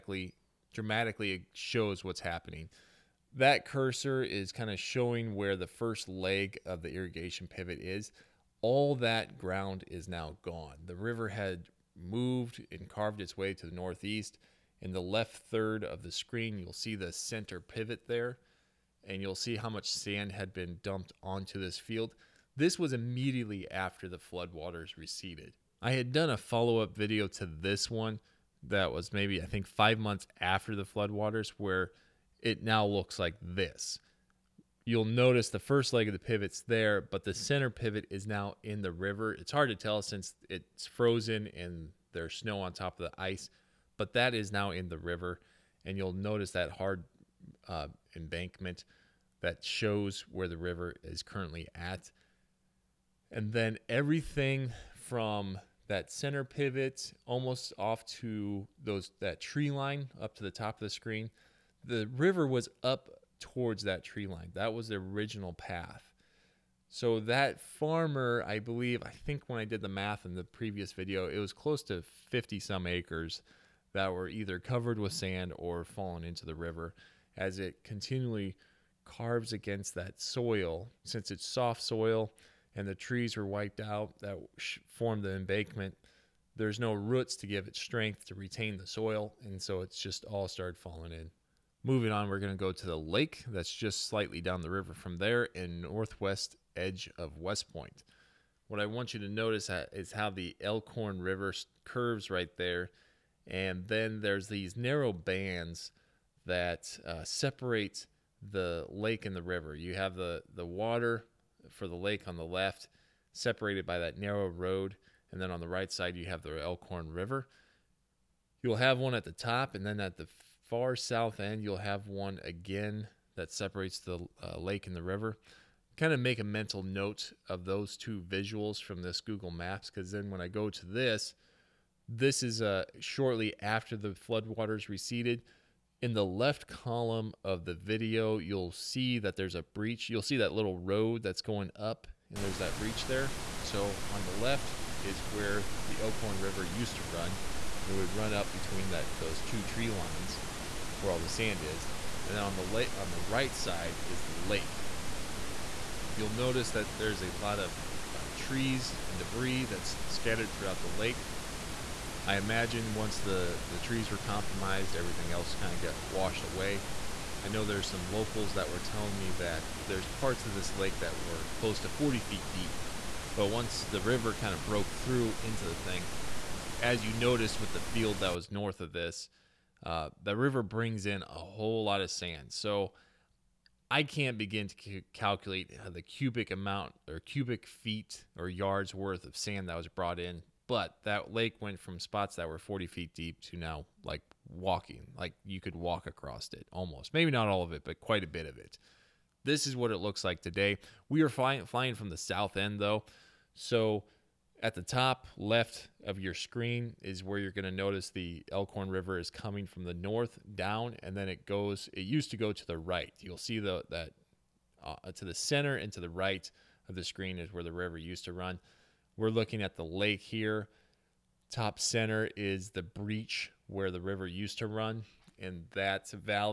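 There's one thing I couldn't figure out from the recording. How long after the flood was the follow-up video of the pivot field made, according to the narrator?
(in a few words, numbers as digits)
5 months.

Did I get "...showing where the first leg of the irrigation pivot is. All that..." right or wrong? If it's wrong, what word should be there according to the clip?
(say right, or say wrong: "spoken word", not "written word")
right.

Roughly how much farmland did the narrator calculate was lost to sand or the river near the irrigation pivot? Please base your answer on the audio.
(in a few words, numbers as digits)
50 some acres.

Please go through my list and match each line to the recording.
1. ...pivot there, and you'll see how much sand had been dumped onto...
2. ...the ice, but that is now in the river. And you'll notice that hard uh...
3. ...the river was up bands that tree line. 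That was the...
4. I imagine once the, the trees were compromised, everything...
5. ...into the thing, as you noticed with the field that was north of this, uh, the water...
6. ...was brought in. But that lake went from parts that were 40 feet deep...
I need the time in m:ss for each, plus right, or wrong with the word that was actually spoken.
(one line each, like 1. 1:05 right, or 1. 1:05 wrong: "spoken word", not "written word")
1. 0:17 right
2. 0:43 right
3. 1:01 wrong: "towards", not "bands"
4. 2:42 right
5. 2:55 wrong: "river", not "water"
6. 3:09 wrong: "spots", not "parts".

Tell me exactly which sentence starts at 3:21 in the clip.
We are fly- flying from the south end though.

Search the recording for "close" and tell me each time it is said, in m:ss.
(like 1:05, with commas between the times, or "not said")
1:11, 2:51.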